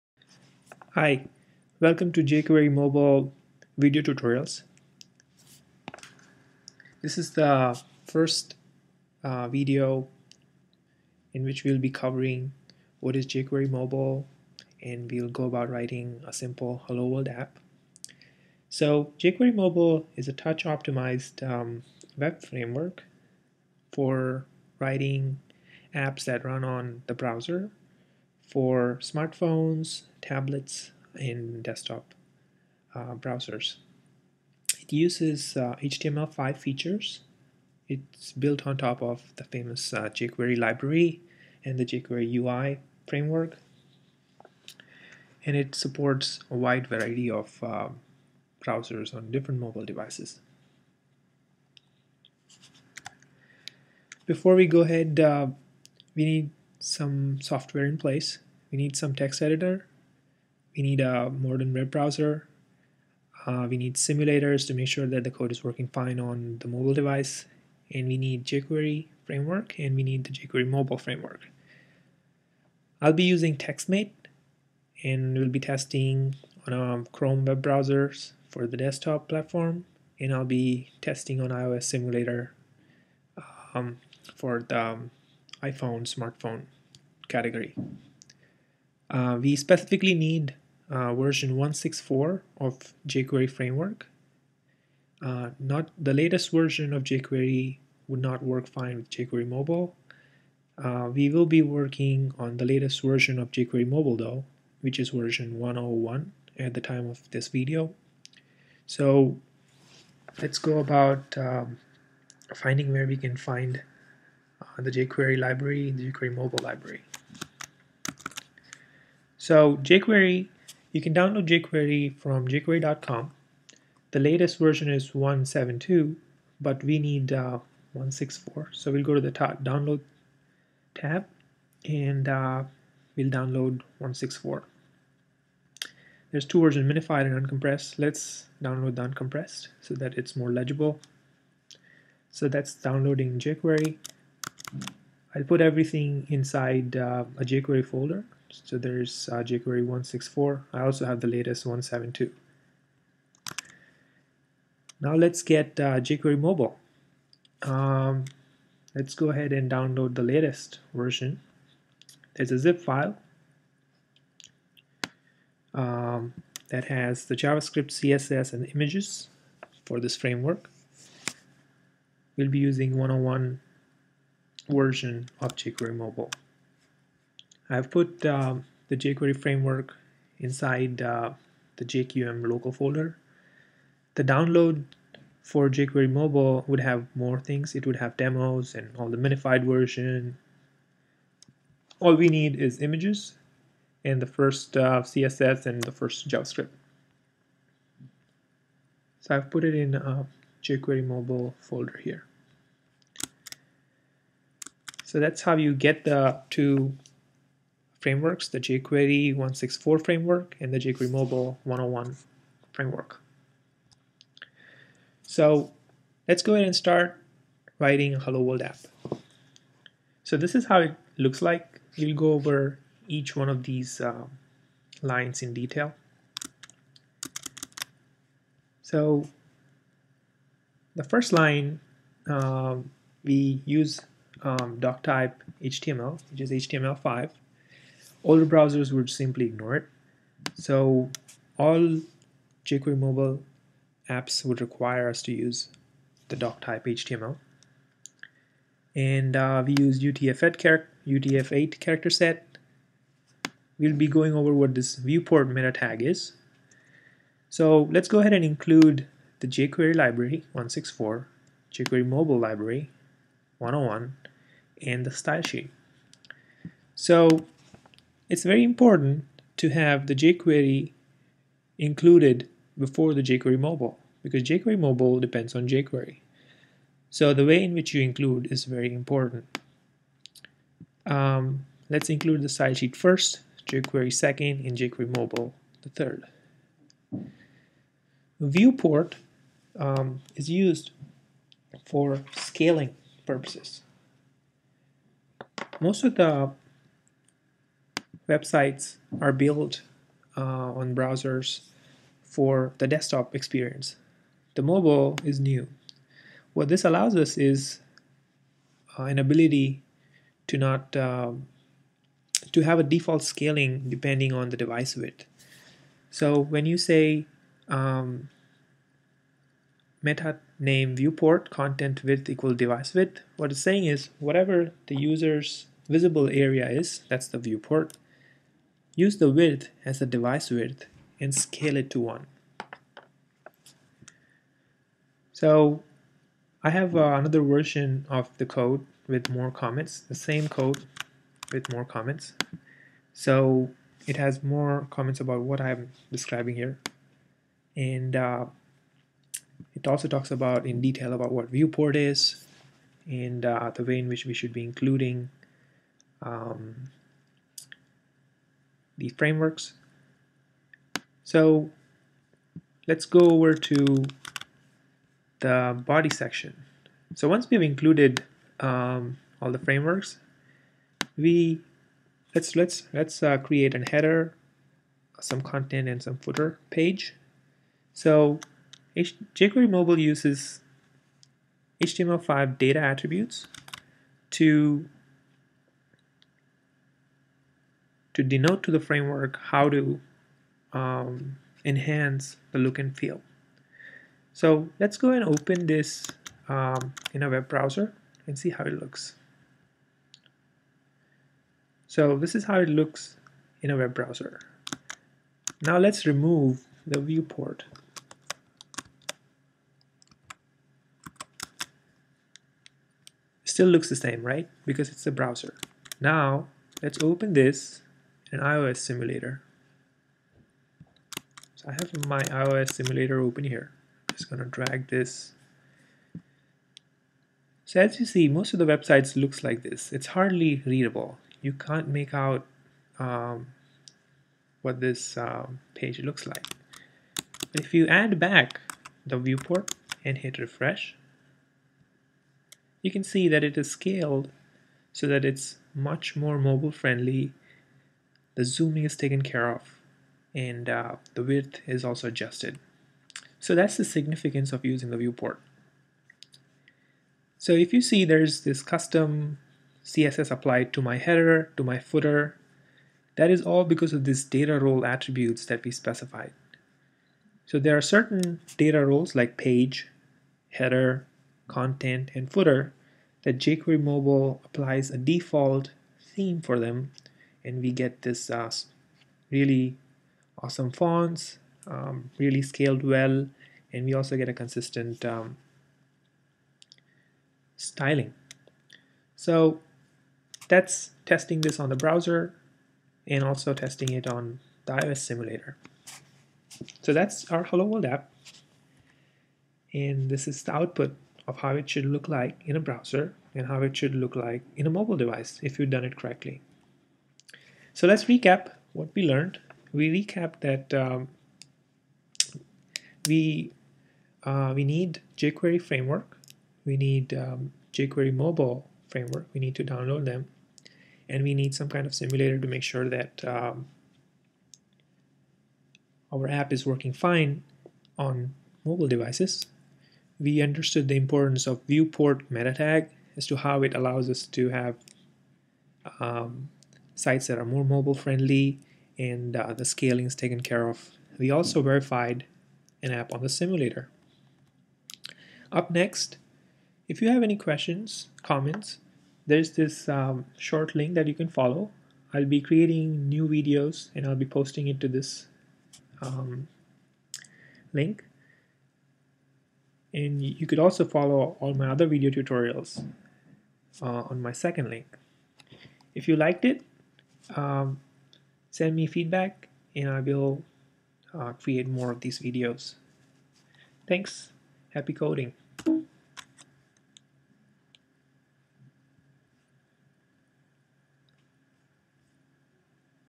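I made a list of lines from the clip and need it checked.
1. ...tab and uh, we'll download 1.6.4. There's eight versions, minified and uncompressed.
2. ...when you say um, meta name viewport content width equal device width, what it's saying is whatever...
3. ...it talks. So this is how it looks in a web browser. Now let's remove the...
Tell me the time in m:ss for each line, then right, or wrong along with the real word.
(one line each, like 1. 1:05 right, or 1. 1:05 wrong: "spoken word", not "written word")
1. 2:10 wrong: "two", not "eight"
2. 5:16 right
3. 6:38 wrong: "looks", not "talks".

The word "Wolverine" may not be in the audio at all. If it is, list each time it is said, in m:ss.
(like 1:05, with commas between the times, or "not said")
not said.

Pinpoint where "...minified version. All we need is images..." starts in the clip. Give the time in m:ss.
3:09.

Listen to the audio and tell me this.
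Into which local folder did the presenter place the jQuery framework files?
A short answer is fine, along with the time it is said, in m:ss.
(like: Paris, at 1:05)
JQM local, at 3:01.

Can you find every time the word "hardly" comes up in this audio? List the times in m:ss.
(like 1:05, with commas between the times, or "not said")
7:10.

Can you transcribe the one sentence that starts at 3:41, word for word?
We'll go over each one of these uh, lines in detail.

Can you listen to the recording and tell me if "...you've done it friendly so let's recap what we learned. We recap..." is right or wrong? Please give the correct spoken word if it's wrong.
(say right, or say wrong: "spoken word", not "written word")
wrong: "correctly", not "friendly".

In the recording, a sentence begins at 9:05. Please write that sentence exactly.
Up next, if you have any questions, comments, there's this um, short link that you can follow.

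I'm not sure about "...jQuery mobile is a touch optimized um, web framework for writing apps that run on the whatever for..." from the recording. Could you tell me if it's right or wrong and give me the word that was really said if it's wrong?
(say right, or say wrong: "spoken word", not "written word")
wrong: "browser", not "whatever".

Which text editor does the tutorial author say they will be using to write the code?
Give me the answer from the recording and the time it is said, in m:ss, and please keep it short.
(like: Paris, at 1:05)
TextMate, at 1:13.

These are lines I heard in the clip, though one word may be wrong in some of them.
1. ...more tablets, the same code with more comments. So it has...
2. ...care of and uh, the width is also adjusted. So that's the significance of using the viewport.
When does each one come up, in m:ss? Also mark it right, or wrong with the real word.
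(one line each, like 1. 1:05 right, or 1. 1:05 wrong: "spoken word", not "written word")
1. 5:39 wrong: "comments", not "tablets"
2. 7:29 right.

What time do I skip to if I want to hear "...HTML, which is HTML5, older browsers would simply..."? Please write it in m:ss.
3:55.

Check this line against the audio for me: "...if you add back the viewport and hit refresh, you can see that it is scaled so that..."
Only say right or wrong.
right.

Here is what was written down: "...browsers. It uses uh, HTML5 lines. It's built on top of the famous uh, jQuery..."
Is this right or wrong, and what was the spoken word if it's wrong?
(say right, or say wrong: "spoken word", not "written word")
wrong: "features", not "lines".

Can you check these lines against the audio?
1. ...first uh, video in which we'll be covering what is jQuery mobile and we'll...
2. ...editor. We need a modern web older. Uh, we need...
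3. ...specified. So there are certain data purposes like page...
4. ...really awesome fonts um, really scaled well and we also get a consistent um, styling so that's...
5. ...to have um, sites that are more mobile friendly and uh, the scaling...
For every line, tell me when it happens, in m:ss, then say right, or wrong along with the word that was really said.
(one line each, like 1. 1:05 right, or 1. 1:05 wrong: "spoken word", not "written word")
1. 0:08 right
2. 0:59 wrong: "browser", not "older"
3. 7:45 wrong: "roles", not "purposes"
4. 7:59 right
5. 8:54 right.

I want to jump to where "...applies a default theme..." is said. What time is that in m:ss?
7:54.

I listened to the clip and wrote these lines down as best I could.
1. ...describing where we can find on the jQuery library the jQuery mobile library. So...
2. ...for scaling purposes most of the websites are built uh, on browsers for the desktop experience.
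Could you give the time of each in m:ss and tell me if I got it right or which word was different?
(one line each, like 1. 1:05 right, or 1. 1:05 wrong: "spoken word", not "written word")
1. 1:52 wrong: "finding", not "describing"
2. 4:51 right.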